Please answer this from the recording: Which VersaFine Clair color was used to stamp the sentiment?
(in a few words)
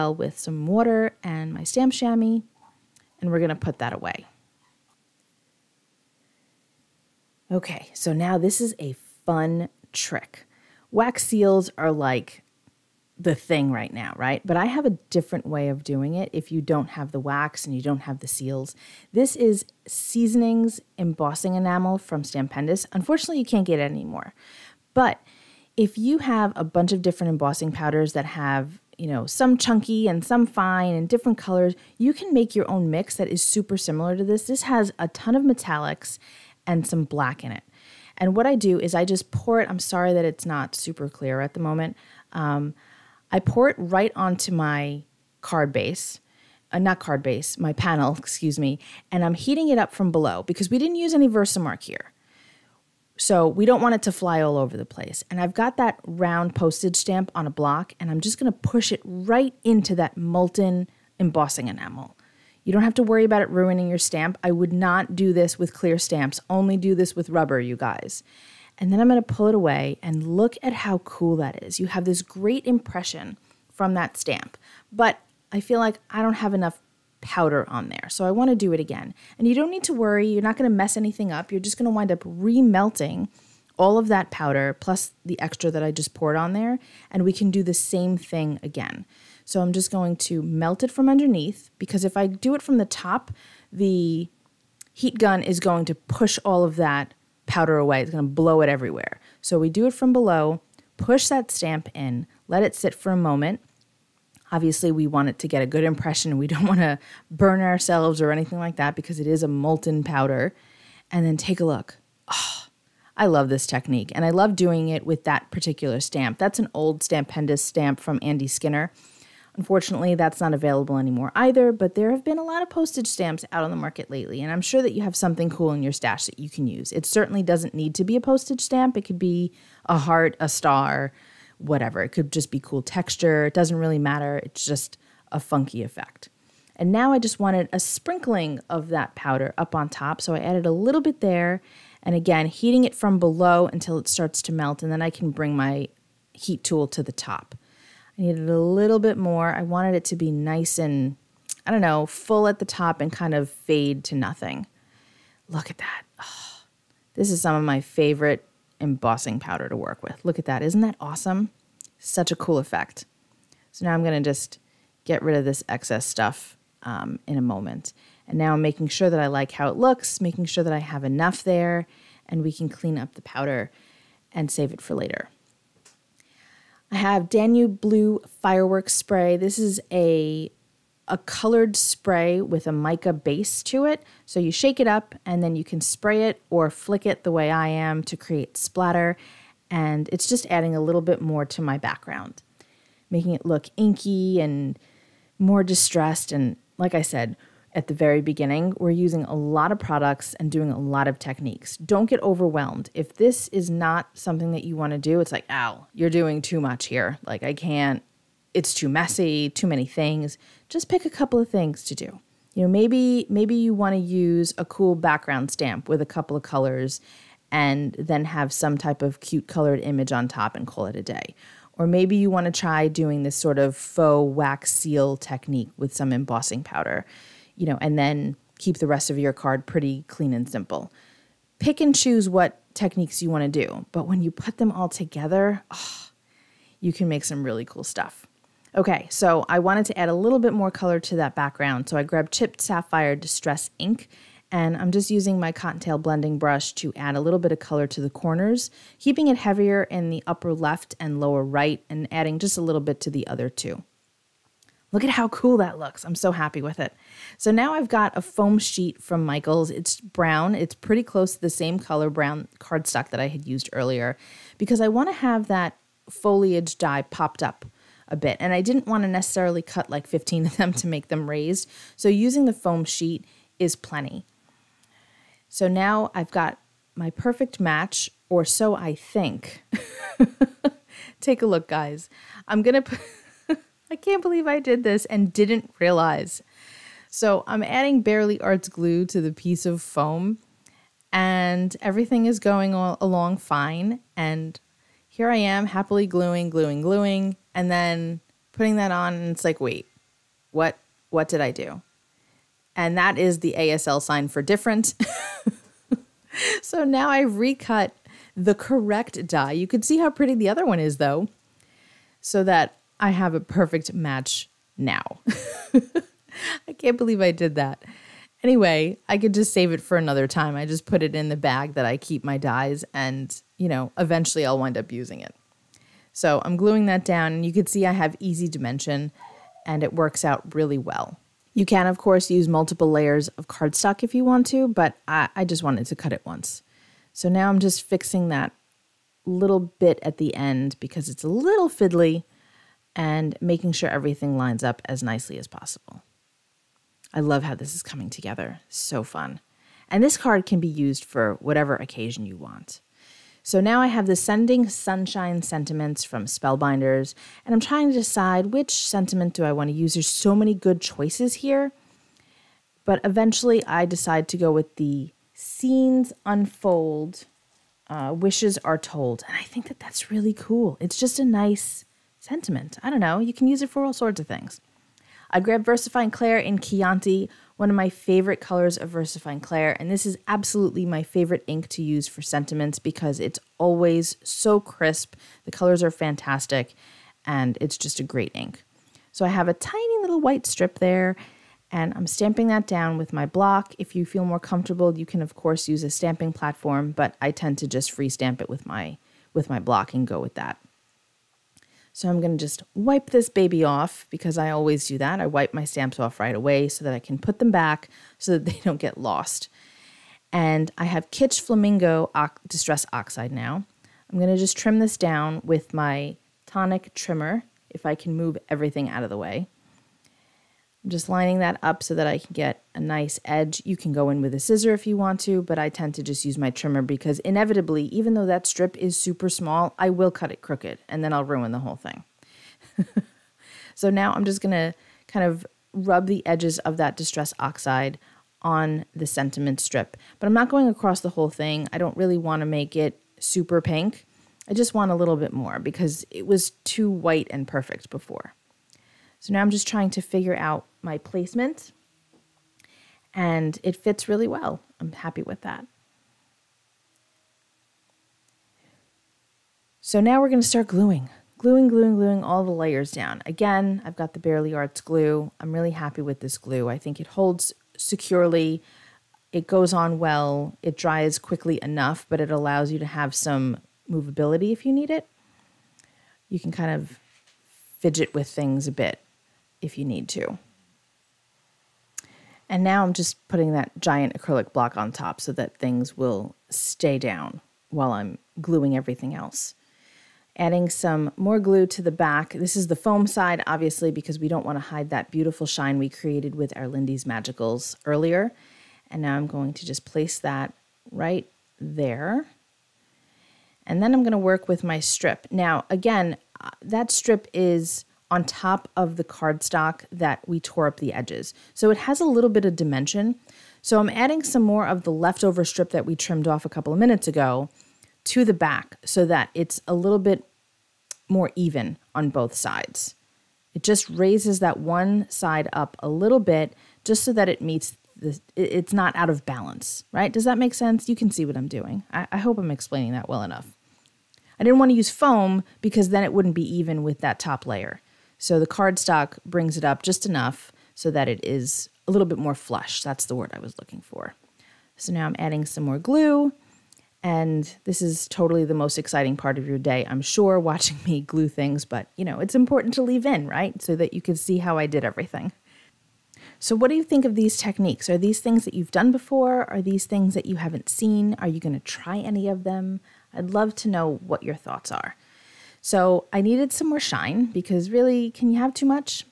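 Chianti.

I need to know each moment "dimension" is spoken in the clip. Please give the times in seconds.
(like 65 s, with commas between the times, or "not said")
328 s, 512 s.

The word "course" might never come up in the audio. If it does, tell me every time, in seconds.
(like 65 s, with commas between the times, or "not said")
331 s, 395 s.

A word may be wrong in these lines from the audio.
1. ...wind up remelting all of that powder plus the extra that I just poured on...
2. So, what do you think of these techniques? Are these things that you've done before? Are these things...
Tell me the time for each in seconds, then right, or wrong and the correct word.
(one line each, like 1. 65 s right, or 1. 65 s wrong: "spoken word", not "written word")
1. 81 s right
2. 556 s right.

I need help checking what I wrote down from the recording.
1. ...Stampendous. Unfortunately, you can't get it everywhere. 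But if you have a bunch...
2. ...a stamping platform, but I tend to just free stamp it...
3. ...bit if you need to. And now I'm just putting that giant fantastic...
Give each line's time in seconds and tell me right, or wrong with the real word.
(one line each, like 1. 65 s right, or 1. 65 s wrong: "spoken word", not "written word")
1. 22 s wrong: "anymore", not "everywhere"
2. 395 s right
3. 478 s wrong: "acrylic", not "fantastic".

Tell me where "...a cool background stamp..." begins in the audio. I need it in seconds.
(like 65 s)
214 s.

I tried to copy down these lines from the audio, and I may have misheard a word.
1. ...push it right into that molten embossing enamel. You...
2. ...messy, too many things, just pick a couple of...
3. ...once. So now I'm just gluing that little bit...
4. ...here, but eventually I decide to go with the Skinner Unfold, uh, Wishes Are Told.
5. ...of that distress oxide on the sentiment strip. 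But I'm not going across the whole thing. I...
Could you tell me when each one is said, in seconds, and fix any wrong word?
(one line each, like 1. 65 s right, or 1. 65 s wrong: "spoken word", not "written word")
1. 58 s right
2. 208 s right
3. 336 s wrong: "fixing", not "gluing"
4. 361 s wrong: "Scenes", not "Skinner"
5. 436 s right.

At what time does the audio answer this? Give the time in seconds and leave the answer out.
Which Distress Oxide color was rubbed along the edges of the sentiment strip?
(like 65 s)
411 s.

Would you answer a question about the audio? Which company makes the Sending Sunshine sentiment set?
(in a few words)
Spellbinders.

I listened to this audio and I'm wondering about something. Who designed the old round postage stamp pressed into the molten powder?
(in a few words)
Andy Skinner.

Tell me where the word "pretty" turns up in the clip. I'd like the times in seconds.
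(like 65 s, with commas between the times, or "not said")
229 s, 260 s, 310 s.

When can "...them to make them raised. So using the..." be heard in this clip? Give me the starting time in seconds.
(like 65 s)
270 s.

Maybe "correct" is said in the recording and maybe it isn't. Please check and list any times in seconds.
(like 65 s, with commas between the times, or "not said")
308 s.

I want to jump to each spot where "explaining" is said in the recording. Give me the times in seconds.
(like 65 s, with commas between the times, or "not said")
532 s.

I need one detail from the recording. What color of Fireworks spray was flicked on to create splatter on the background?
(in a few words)
Danube Blue.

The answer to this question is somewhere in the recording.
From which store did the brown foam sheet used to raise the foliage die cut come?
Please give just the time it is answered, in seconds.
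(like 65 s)
259 s.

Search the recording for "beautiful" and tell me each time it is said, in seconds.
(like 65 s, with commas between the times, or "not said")
495 s.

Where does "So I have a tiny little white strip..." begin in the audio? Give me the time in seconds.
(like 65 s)
389 s.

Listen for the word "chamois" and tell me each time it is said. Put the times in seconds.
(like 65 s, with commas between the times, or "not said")
1 s.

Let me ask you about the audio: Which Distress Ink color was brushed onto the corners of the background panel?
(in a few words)
Chipped Sapphire.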